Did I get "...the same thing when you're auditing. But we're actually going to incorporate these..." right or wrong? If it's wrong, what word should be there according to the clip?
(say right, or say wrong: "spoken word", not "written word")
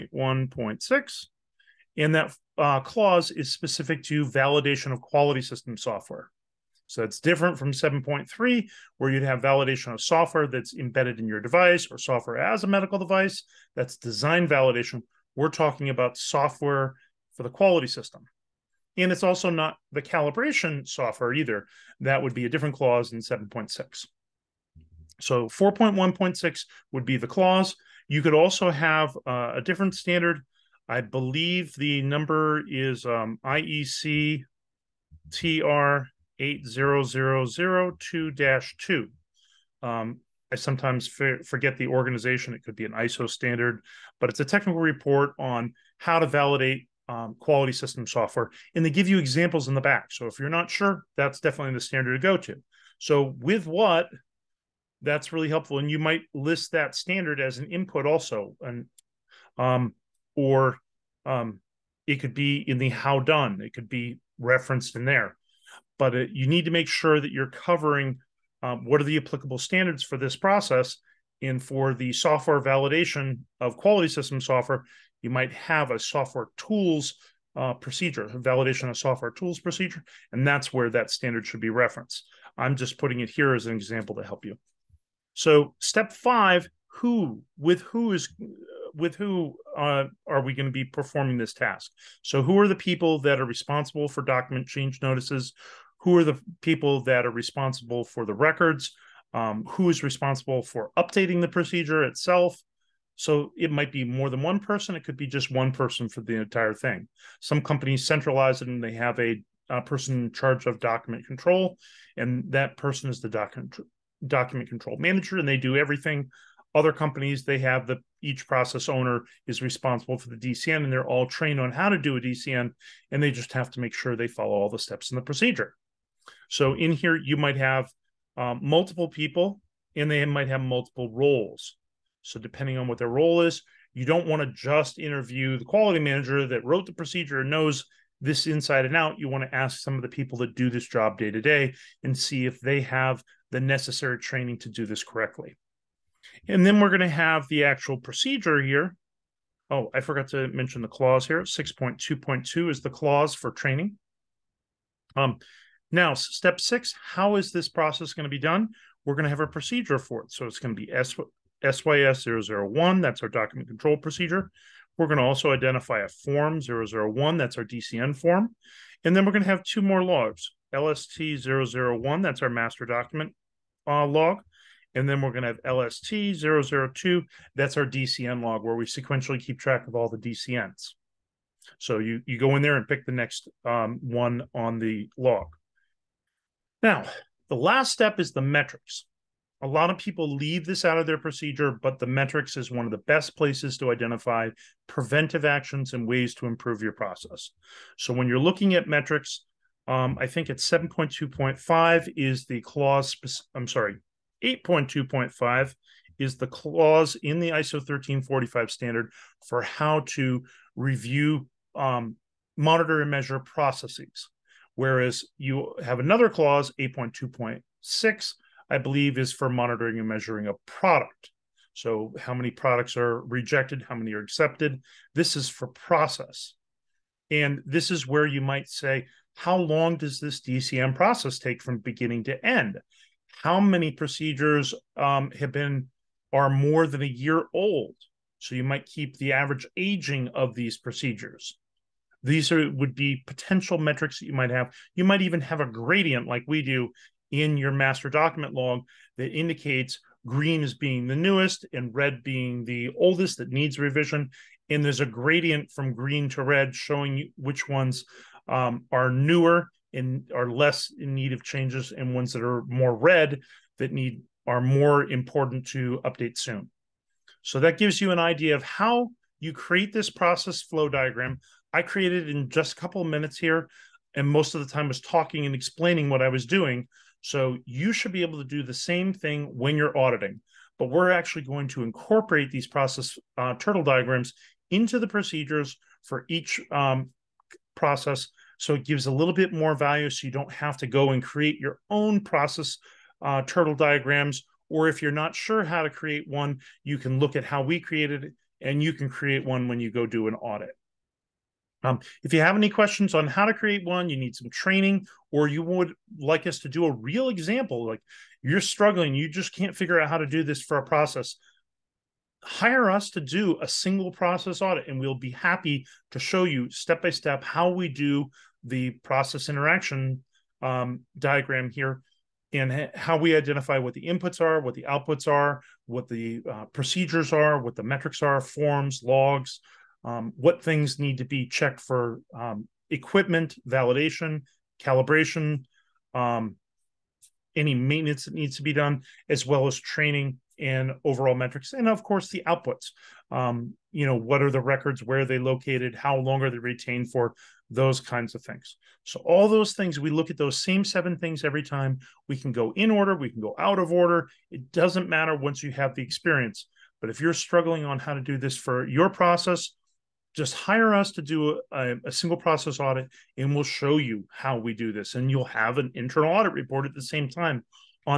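right.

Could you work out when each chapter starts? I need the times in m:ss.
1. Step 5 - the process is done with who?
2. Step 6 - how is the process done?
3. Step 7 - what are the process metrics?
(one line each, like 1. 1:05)
1. 1:24
2. 2:35
3. 3:06.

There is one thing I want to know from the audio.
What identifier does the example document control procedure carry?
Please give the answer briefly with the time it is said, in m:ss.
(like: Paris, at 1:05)
SYS 001, at 2:40.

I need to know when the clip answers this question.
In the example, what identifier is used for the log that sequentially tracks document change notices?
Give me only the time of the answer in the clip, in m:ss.
2:55.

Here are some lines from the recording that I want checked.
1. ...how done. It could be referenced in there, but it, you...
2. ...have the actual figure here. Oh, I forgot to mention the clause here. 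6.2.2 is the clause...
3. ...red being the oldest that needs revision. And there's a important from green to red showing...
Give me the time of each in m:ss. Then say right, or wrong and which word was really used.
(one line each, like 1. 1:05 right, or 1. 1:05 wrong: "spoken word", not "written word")
1. 1:02 right
2. 2:27 wrong: "procedure", not "figure"
3. 4:11 wrong: "gradient", not "important".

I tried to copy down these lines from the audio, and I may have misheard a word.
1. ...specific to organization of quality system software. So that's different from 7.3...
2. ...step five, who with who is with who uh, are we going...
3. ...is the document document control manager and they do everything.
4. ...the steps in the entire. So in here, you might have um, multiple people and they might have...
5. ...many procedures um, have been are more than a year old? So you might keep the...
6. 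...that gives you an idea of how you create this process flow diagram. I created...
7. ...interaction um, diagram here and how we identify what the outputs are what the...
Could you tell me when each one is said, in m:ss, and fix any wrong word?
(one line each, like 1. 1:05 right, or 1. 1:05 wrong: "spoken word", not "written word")
1. 0:03 wrong: "validation", not "organization"
2. 1:25 right
3. 1:53 right
4. 2:04 wrong: "procedure", not "entire"
5. 3:53 right
6. 4:27 right
7. 5:19 wrong: "inputs", not "outputs".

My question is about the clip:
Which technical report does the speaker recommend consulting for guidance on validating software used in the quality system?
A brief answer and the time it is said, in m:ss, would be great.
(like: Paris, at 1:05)
IEC TR 80002-2, at 0:33.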